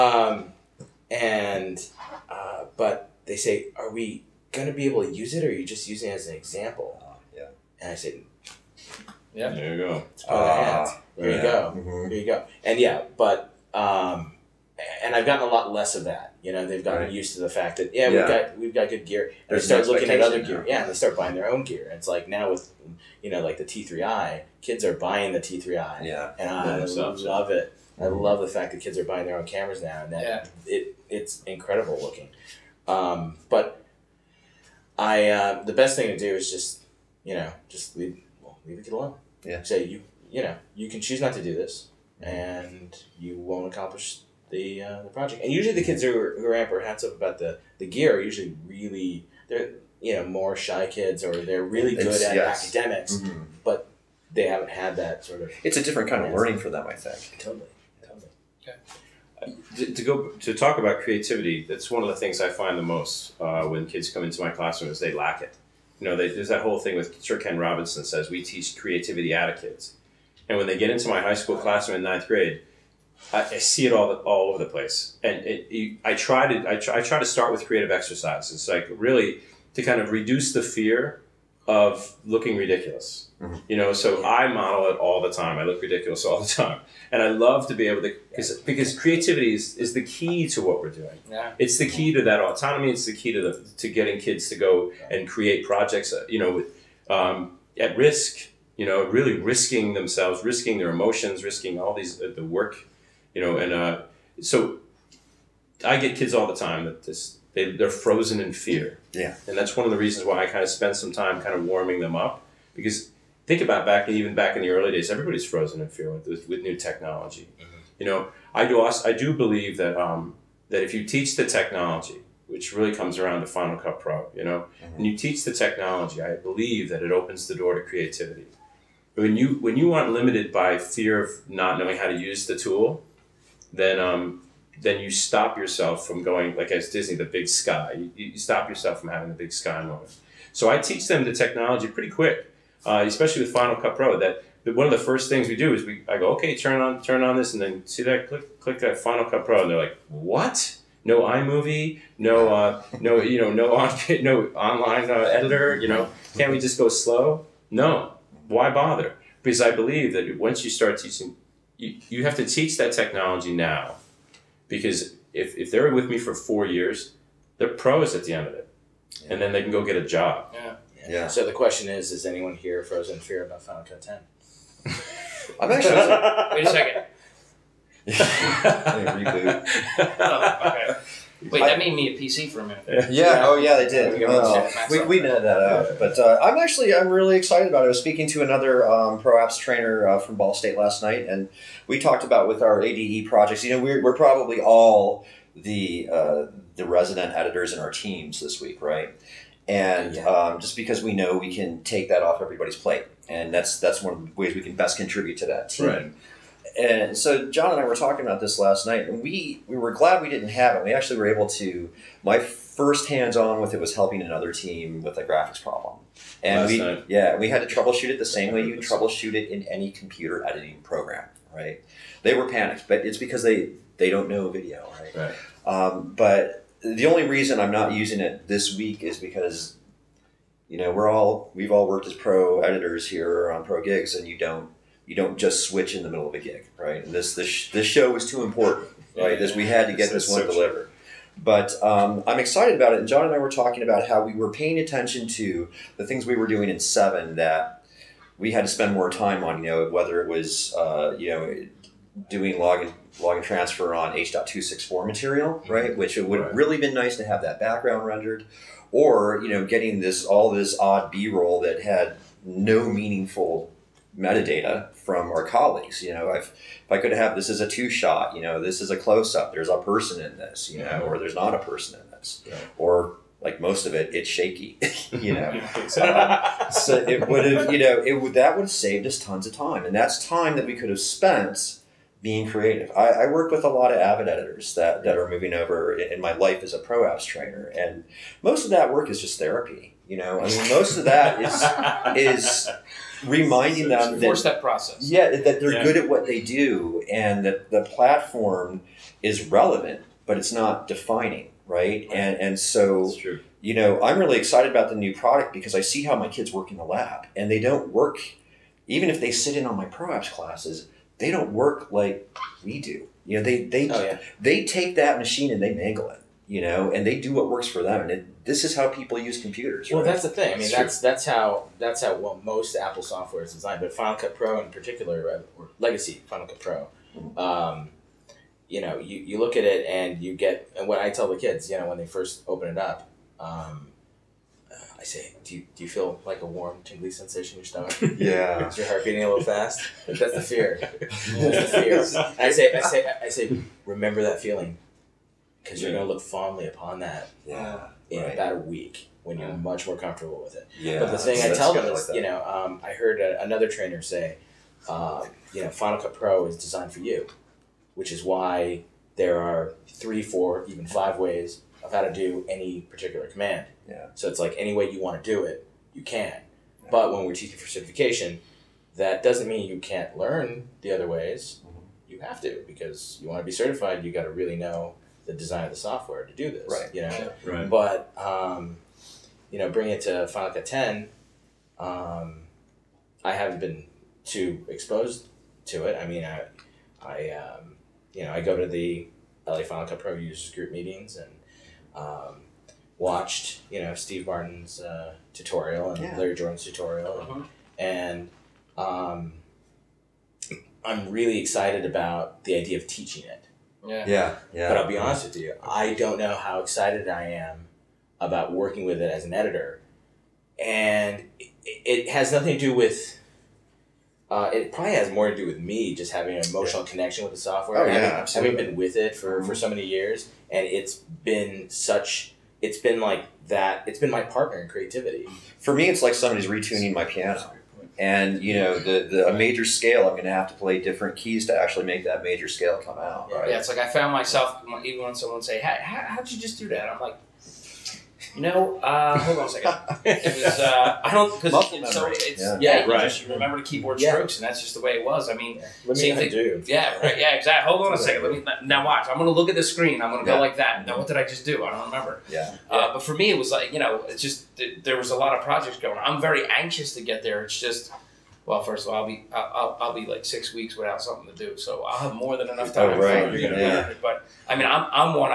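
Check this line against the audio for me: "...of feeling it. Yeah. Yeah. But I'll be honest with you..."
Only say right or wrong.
wrong.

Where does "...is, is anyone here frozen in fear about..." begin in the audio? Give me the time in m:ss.
2:51.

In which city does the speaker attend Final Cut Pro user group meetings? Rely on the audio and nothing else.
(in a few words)
LA.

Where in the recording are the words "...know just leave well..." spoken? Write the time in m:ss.
0:37.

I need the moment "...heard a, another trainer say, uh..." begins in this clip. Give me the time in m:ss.
5:52.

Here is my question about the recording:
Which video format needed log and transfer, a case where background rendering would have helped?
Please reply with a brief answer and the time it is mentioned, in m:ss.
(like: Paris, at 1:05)
H.264, at 4:14.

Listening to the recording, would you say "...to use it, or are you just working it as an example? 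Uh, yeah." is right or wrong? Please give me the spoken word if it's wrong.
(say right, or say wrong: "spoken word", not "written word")
wrong: "using", not "working".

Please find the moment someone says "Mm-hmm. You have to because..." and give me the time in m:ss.
6:11.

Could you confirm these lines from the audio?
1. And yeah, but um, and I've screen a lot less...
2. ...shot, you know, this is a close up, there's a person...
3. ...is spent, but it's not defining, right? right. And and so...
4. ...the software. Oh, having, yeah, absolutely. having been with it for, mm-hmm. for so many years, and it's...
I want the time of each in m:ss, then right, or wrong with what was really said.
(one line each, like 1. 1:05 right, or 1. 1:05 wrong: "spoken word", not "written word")
1. 0:12 wrong: "gotten", not "screen"
2. 4:27 right
3. 4:59 wrong: "relevant", not "spent"
4. 6:57 right.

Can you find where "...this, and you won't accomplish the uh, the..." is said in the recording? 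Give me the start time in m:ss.
0:41.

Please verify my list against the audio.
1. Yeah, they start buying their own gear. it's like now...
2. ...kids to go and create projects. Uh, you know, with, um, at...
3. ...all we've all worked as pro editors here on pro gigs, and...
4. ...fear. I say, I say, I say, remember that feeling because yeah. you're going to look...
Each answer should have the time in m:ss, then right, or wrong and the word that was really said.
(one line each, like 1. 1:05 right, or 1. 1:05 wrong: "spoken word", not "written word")
1. 0:20 right
2. 1:34 right
3. 3:51 right
4. 5:41 right.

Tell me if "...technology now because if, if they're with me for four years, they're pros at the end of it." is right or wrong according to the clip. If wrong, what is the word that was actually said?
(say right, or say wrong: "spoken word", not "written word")
right.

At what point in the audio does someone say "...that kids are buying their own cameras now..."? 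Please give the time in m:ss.
0:28.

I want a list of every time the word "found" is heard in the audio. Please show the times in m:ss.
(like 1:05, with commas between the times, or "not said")
7:13.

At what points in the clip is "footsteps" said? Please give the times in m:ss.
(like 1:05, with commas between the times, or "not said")
not said.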